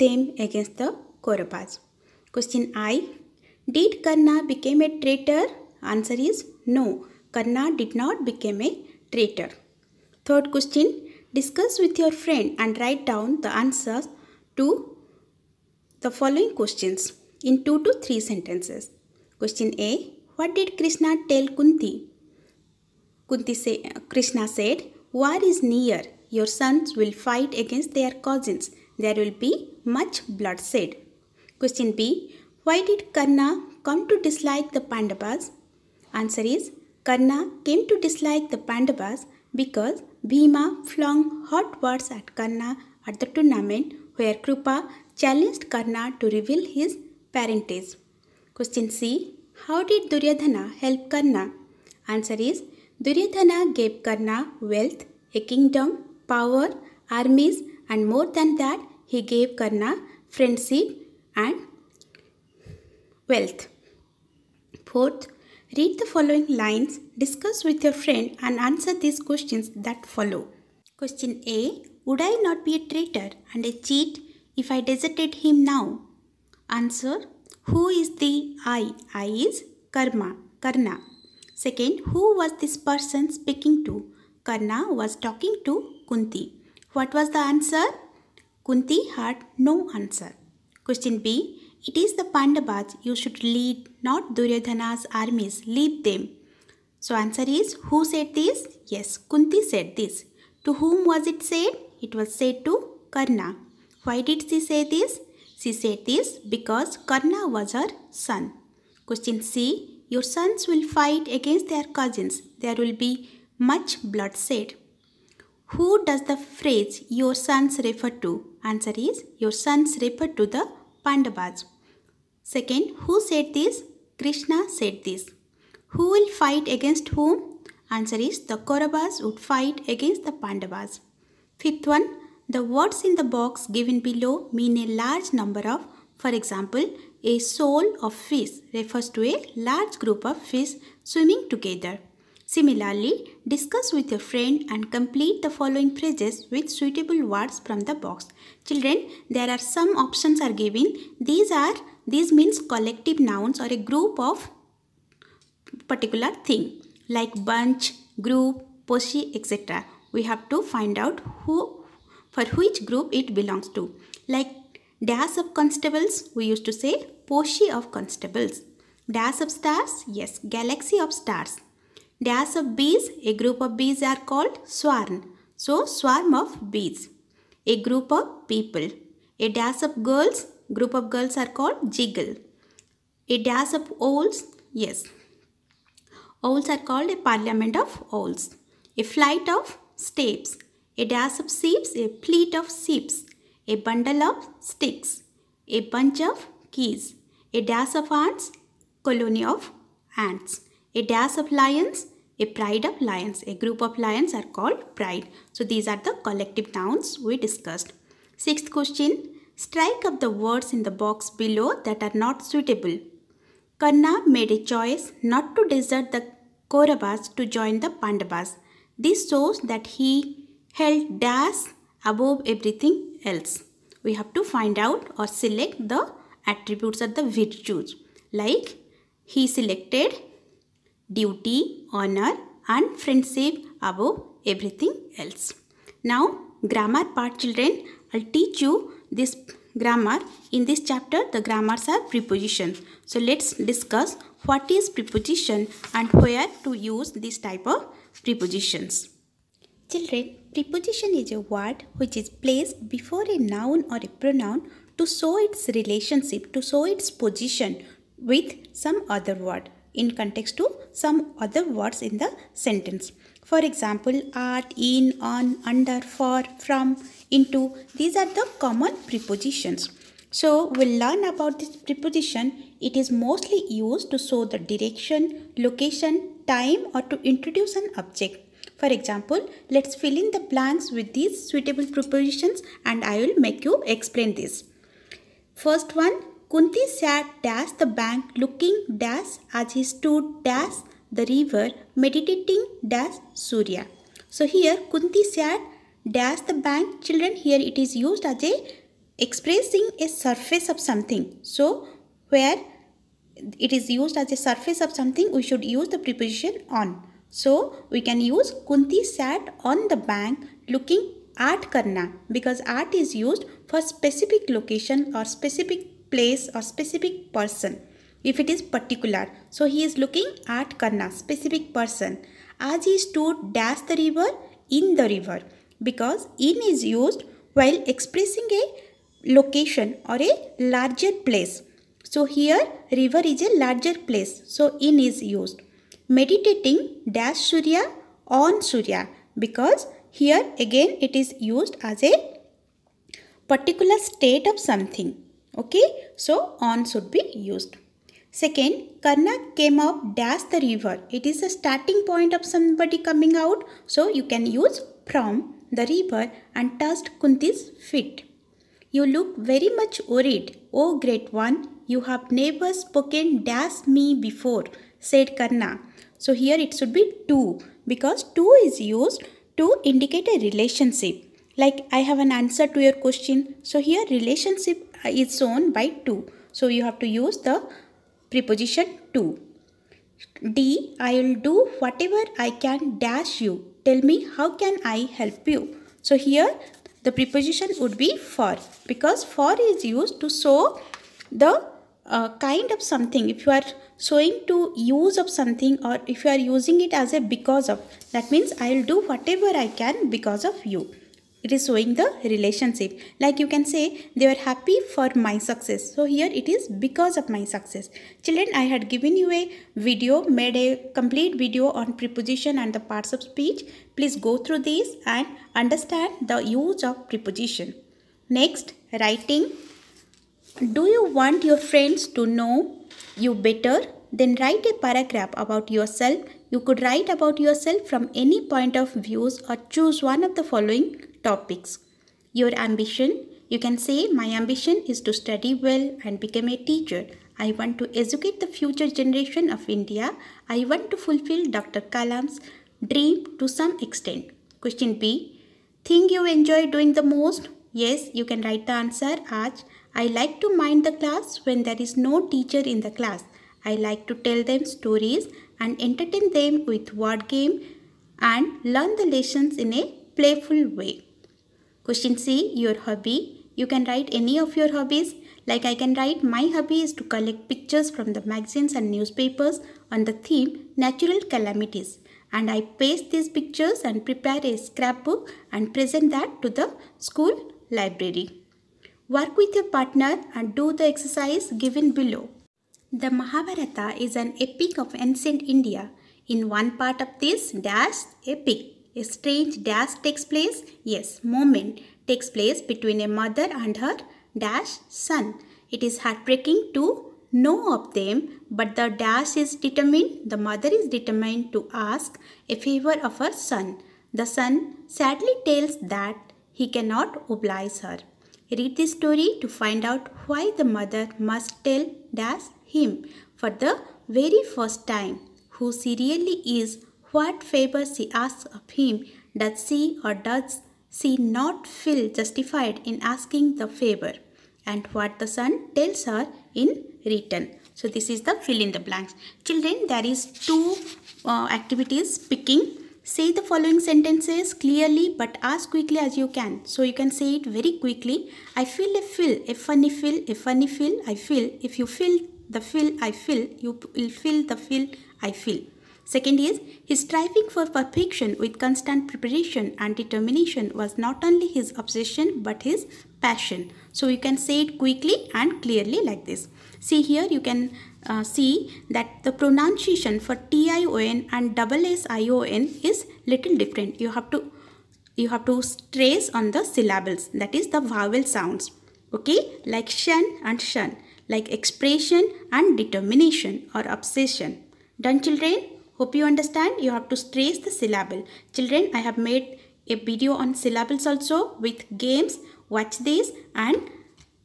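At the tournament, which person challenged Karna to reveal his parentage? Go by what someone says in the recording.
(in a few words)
Krupa.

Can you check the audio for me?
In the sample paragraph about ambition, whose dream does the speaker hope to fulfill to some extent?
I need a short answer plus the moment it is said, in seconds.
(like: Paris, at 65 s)
Dr. Kalam, at 441 s.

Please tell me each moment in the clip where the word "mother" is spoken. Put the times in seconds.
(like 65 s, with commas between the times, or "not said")
493 s, 500 s, 510 s.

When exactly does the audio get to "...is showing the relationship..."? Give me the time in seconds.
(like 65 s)
401 s.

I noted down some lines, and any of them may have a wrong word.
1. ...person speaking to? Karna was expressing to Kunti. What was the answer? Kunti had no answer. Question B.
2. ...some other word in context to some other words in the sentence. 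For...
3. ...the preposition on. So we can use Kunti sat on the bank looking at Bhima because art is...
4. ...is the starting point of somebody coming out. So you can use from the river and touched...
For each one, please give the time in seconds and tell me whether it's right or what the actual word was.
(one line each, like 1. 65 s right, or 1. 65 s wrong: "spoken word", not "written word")
1. 82 s wrong: "talking", not "expressing"
2. 258 s right
3. 305 s wrong: "Karna", not "Bhima"
4. 351 s right.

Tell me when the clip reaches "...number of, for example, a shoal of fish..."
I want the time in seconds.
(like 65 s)
135 s.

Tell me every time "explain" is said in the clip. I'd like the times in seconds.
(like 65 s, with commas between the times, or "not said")
283 s.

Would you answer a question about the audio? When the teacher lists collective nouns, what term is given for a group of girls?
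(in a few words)
jiggle.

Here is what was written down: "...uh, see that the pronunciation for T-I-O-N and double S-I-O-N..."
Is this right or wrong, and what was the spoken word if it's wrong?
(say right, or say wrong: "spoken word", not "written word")
right.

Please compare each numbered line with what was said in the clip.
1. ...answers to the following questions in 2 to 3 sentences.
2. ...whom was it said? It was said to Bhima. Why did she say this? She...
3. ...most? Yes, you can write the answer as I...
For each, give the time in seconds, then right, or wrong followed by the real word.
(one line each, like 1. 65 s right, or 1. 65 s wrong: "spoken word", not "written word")
1. 13 s right
2. 100 s wrong: "Karna", not "Bhima"
3. 447 s right.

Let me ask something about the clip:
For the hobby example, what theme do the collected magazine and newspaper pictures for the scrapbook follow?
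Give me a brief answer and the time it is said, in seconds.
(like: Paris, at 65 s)
natural calamities, at 470 s.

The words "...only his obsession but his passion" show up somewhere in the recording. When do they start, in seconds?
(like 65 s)
551 s.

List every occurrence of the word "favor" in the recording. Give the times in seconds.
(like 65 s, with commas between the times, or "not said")
502 s, 517 s, 523 s.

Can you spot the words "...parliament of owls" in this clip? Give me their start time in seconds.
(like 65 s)
187 s.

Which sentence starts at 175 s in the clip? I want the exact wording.
So swarm of bees, a group of people.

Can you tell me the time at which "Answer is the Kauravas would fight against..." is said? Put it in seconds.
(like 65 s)
127 s.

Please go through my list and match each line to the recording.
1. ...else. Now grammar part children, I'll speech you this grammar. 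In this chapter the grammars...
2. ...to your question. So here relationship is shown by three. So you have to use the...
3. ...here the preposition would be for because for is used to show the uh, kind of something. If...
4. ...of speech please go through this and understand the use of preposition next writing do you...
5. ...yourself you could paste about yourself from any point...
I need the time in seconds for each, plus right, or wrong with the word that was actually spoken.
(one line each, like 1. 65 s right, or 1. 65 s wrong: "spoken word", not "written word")
1. 235 s wrong: "teach", not "speech"
2. 372 s wrong: "two", not "three"
3. 386 s right
4. 413 s right
5. 425 s wrong: "write", not "paste".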